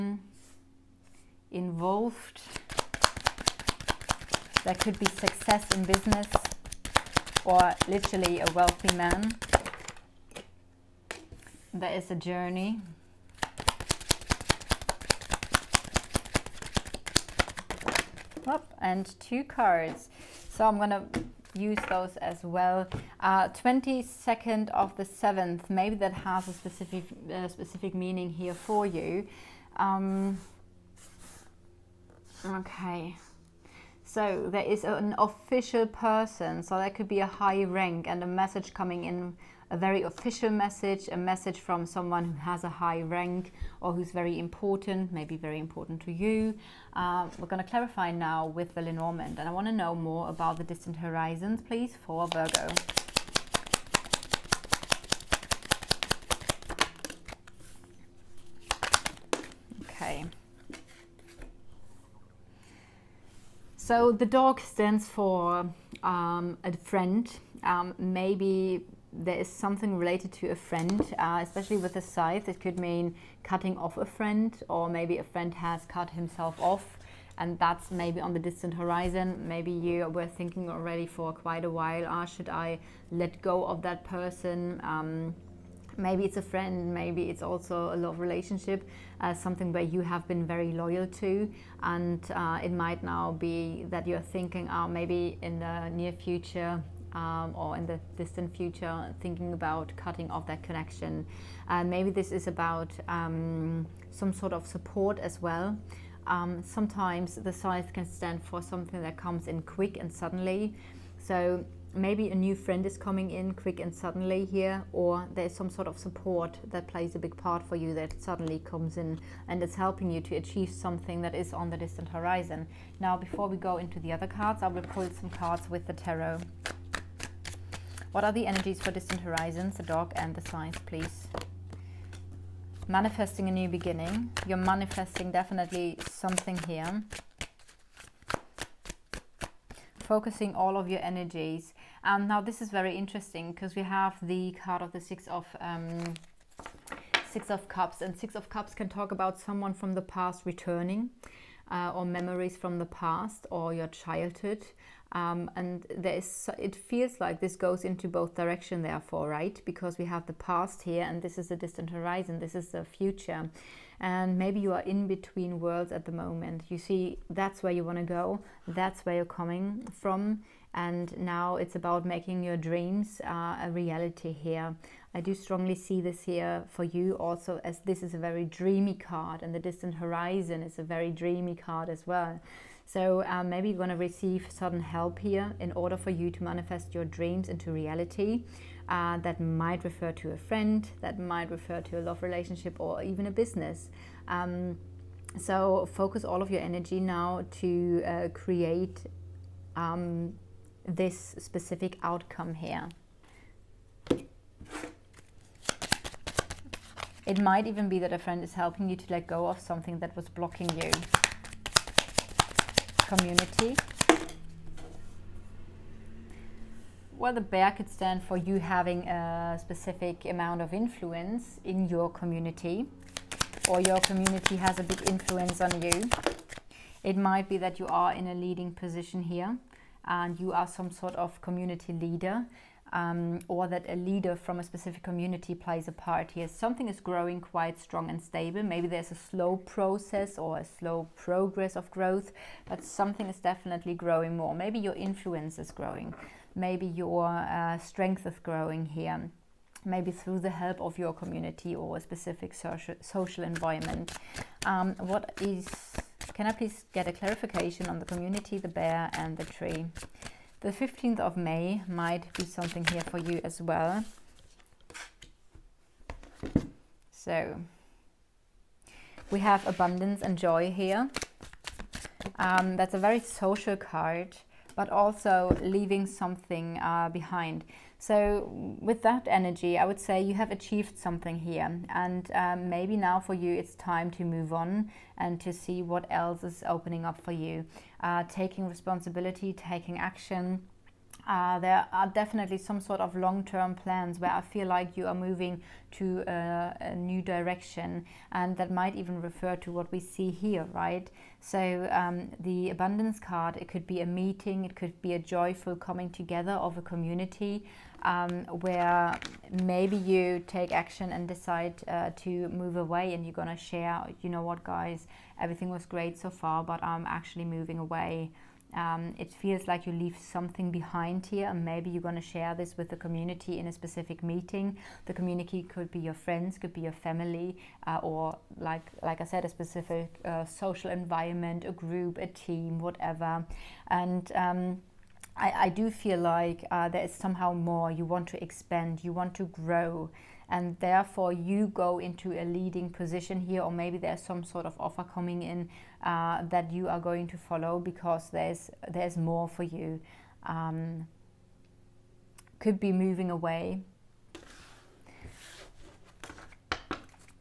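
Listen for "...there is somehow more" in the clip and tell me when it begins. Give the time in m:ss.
5:36.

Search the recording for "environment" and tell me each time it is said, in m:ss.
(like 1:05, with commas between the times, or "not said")
4:13, 5:30.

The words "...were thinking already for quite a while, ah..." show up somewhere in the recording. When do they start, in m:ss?
1:20.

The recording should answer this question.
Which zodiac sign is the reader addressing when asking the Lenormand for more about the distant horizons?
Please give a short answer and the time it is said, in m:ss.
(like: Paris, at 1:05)
Virgo, at 0:52.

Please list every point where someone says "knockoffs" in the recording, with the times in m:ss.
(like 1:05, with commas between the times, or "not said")
not said.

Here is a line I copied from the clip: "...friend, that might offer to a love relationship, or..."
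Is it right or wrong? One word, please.
wrong.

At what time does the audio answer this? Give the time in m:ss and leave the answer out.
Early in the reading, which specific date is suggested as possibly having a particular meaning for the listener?
0:23.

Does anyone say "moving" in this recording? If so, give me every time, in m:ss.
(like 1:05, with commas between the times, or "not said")
4:55, 5:17, 5:52.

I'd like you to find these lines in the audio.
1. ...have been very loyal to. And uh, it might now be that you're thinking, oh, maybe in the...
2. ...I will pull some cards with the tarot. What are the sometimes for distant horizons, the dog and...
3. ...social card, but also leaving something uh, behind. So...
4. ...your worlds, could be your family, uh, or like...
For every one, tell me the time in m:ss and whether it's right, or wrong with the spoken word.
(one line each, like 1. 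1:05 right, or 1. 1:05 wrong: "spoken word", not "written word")
1. 1:30 right
2. 2:04 wrong: "energies", not "sometimes"
3. 4:33 right
4. 5:25 wrong: "friends", not "worlds".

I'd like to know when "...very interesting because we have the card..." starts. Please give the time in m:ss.
2:22.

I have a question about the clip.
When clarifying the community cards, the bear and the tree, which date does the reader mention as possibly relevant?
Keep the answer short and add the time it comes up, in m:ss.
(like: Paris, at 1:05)
15th of May, at 4:20.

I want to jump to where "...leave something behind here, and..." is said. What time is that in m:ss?
5:19.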